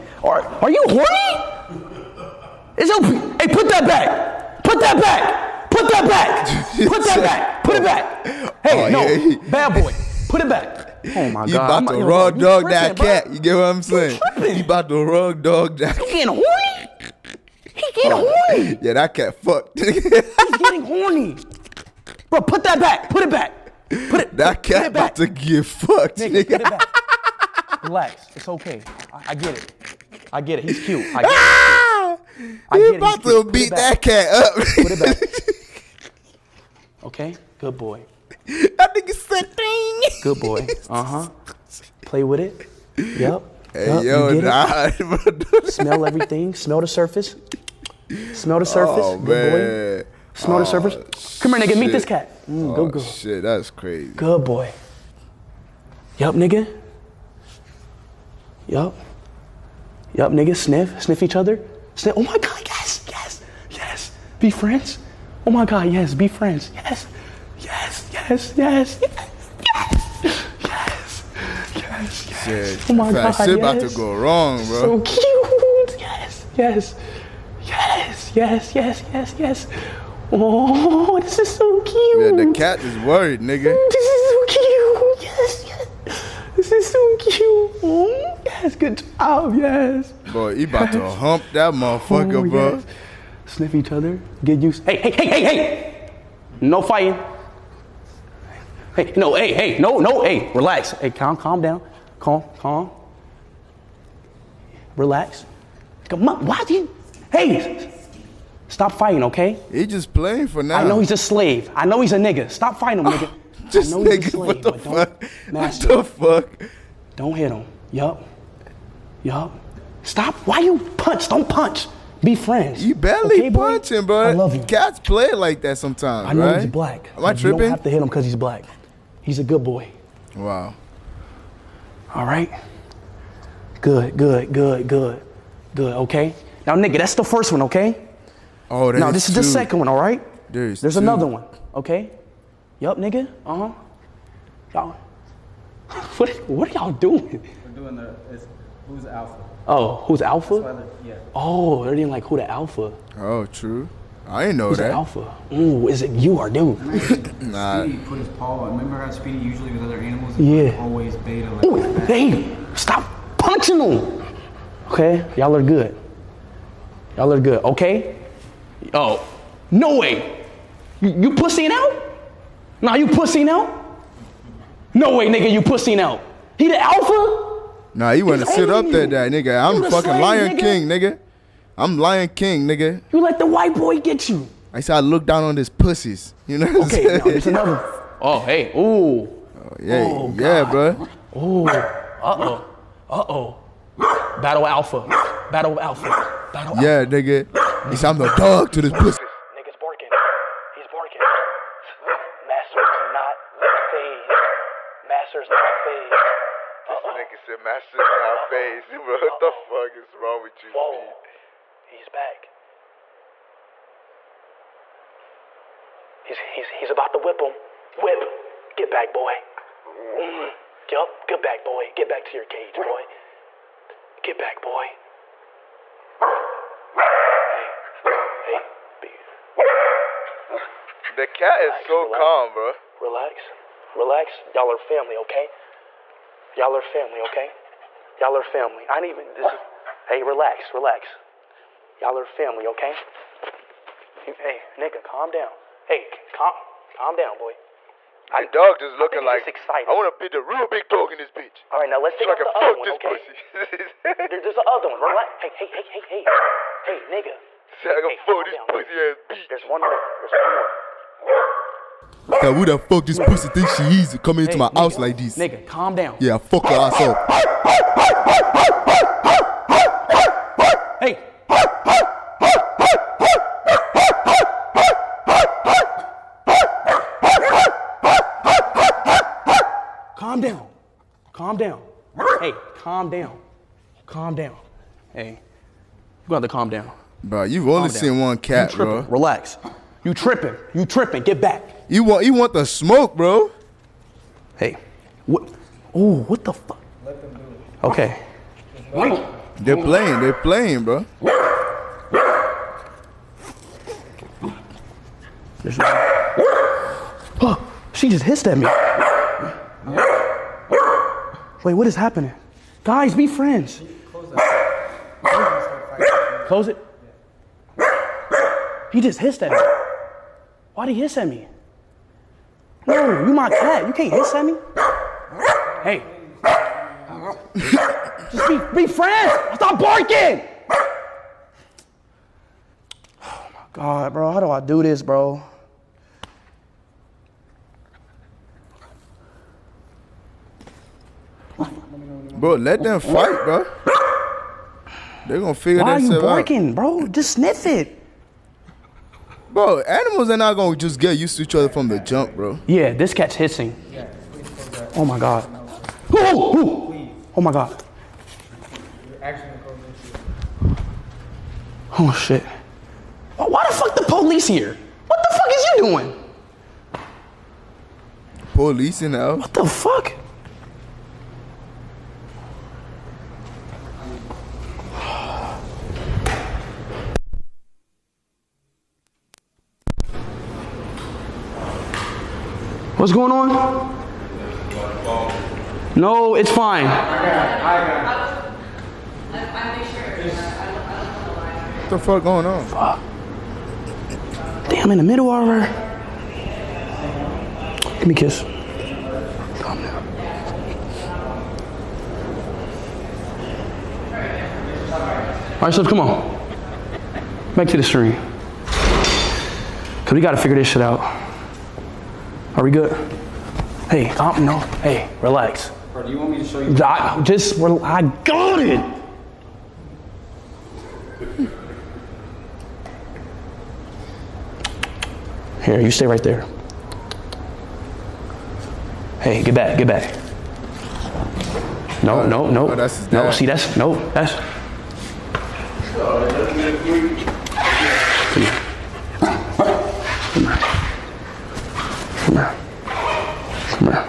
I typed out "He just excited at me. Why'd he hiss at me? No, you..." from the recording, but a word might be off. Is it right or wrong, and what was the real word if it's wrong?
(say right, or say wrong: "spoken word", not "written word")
wrong: "hissed", not "excited".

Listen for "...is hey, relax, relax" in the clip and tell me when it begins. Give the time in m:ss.
3:59.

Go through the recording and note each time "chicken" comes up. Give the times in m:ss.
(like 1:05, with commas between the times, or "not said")
not said.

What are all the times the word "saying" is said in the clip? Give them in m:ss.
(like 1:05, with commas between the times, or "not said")
0:13, 3:07.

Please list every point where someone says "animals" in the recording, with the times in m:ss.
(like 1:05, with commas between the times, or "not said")
2:39, 5:49.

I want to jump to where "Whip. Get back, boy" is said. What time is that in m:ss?
3:37.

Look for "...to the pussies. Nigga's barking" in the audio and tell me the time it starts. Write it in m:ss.
3:18.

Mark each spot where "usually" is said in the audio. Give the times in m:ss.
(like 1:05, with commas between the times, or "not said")
2:39.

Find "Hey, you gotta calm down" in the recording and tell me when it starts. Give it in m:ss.
4:45.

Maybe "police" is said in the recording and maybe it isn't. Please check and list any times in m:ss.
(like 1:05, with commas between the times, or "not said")
6:04, 6:08.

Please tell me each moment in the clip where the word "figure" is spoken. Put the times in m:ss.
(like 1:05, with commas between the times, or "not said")
5:45, 6:50.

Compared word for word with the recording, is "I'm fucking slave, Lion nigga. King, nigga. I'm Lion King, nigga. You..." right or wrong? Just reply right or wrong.
right.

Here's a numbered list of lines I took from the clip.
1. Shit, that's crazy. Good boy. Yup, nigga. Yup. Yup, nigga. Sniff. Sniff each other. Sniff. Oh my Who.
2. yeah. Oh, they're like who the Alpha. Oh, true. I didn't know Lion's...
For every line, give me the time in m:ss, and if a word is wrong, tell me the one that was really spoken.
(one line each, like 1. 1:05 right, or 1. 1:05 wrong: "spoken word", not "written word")
1. 0:52 wrong: "God", not "Who"
2. 2:31 wrong: "Who", not "Lion".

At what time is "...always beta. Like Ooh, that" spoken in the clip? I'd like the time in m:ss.
2:40.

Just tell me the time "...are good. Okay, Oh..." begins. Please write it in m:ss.
2:47.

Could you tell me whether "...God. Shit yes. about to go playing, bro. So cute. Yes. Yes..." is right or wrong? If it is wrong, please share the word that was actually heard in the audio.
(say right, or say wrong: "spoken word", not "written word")
wrong: "wrong", not "playing".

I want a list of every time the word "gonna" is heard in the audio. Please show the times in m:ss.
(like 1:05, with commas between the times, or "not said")
5:45, 5:50.